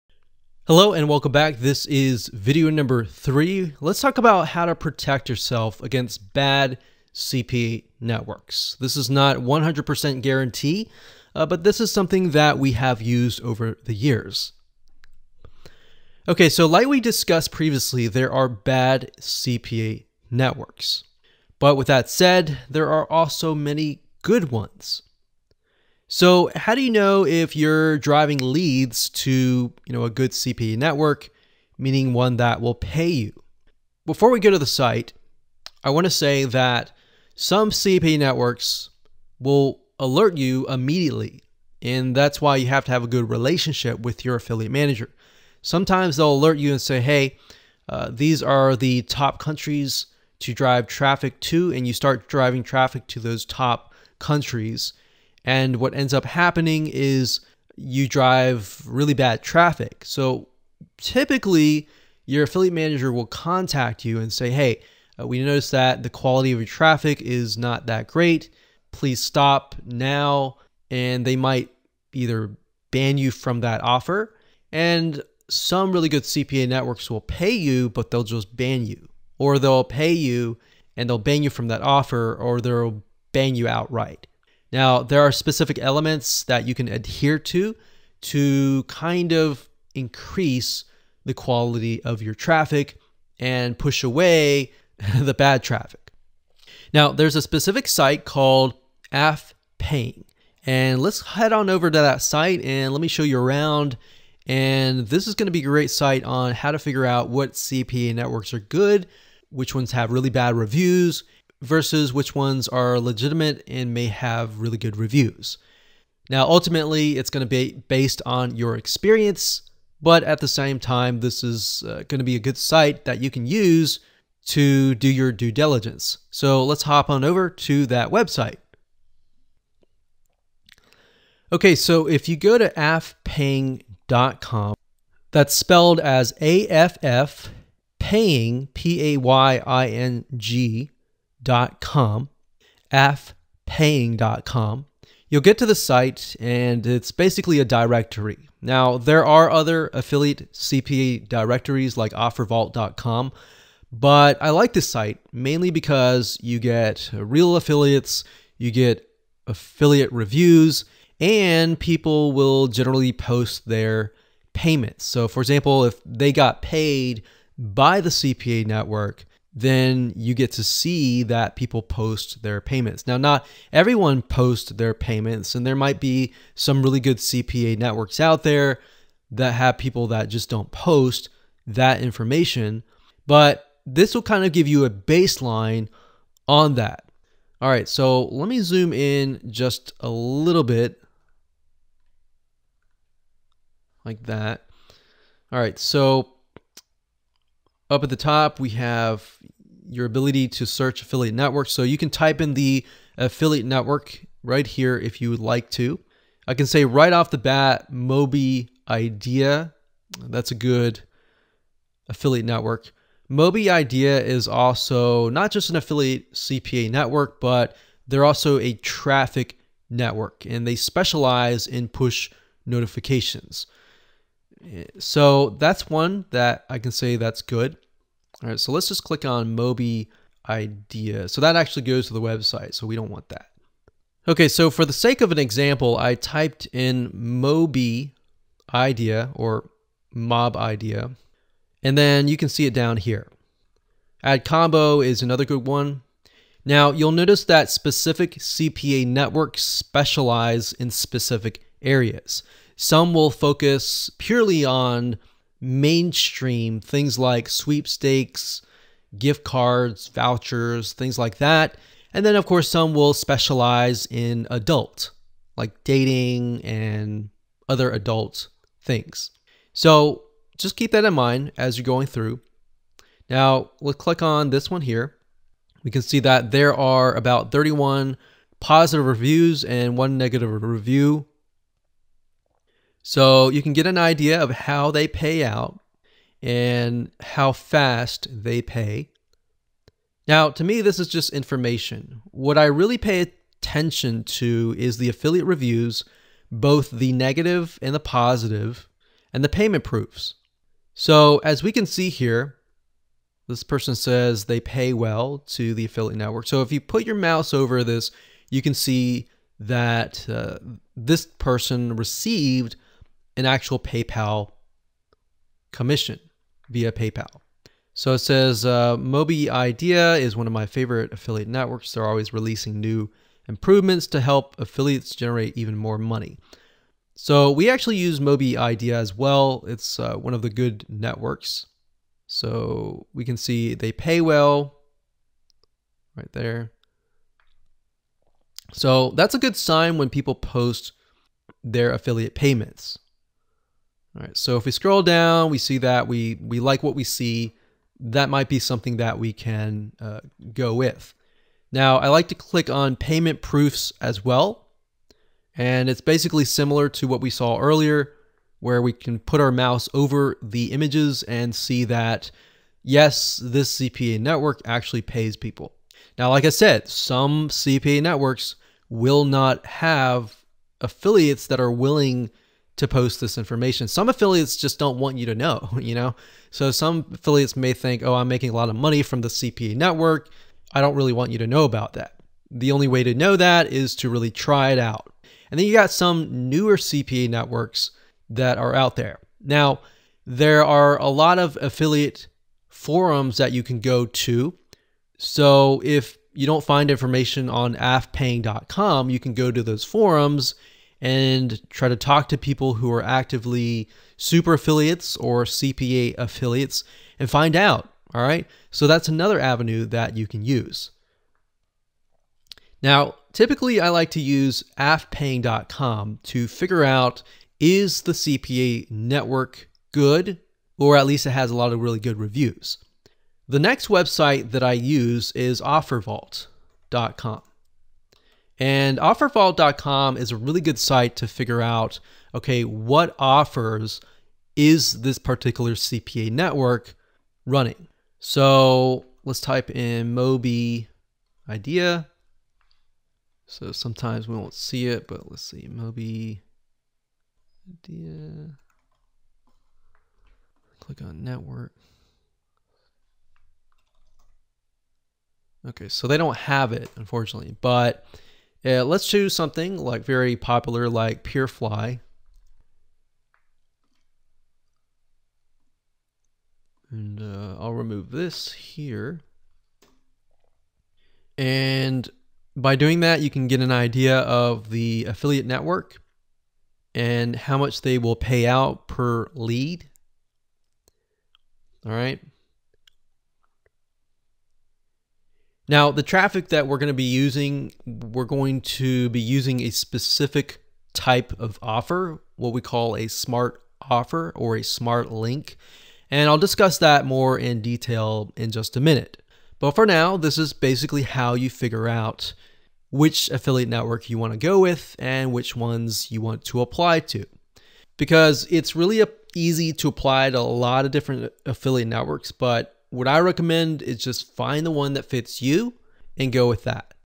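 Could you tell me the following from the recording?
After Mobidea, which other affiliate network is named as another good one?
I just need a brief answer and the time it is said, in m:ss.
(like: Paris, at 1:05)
AdCombo, at 4:04.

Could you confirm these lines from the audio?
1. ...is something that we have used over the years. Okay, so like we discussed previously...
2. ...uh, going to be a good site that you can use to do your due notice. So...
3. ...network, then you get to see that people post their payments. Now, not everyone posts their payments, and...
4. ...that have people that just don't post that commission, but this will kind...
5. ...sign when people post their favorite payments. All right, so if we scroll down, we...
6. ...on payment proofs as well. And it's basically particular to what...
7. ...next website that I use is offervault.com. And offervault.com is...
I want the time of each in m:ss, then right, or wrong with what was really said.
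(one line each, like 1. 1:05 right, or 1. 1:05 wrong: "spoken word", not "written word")
1. 0:11 right
2. 2:01 wrong: "diligence", not "notice"
3. 2:48 right
4. 2:59 wrong: "information", not "commission"
5. 5:39 wrong: "affiliate", not "favorite"
6. 5:52 wrong: "similar", not "particular"
7. 7:03 right.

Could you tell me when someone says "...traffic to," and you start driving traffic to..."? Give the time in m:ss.
0:50.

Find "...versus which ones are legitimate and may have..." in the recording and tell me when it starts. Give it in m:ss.
1:51.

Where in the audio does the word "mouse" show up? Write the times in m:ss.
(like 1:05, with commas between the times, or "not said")
5:07, 5:59.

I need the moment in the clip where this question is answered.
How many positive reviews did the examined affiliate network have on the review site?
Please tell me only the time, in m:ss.
4:37.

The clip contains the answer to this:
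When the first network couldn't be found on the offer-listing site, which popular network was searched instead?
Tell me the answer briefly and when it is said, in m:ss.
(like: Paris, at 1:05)
PeerFly, at 7:41.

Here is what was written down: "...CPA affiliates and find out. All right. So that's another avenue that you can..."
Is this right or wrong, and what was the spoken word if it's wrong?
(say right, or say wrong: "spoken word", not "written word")
right.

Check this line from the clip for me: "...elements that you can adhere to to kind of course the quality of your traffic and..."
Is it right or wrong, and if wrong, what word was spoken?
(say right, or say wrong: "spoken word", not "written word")
wrong: "increase", not "course".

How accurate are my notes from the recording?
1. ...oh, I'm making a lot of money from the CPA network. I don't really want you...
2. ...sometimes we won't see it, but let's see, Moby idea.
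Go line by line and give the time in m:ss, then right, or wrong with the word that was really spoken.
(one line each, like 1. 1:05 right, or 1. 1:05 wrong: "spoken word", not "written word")
1. 6:18 right
2. 7:23 right.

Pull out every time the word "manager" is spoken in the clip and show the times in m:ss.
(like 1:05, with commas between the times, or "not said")
0:44, 1:02.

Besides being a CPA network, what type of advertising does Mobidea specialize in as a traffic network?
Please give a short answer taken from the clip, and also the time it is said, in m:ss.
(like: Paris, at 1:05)
push notifications, at 3:41.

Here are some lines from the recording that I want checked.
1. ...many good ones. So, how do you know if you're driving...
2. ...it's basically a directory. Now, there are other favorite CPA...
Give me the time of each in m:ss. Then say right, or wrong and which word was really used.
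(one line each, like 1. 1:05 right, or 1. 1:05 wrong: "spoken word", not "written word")
1. 0:23 right
2. 2:26 wrong: "affiliate", not "favorite".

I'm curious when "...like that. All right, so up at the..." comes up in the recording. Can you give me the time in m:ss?
3:14.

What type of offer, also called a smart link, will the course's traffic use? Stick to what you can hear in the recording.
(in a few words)
smart offer.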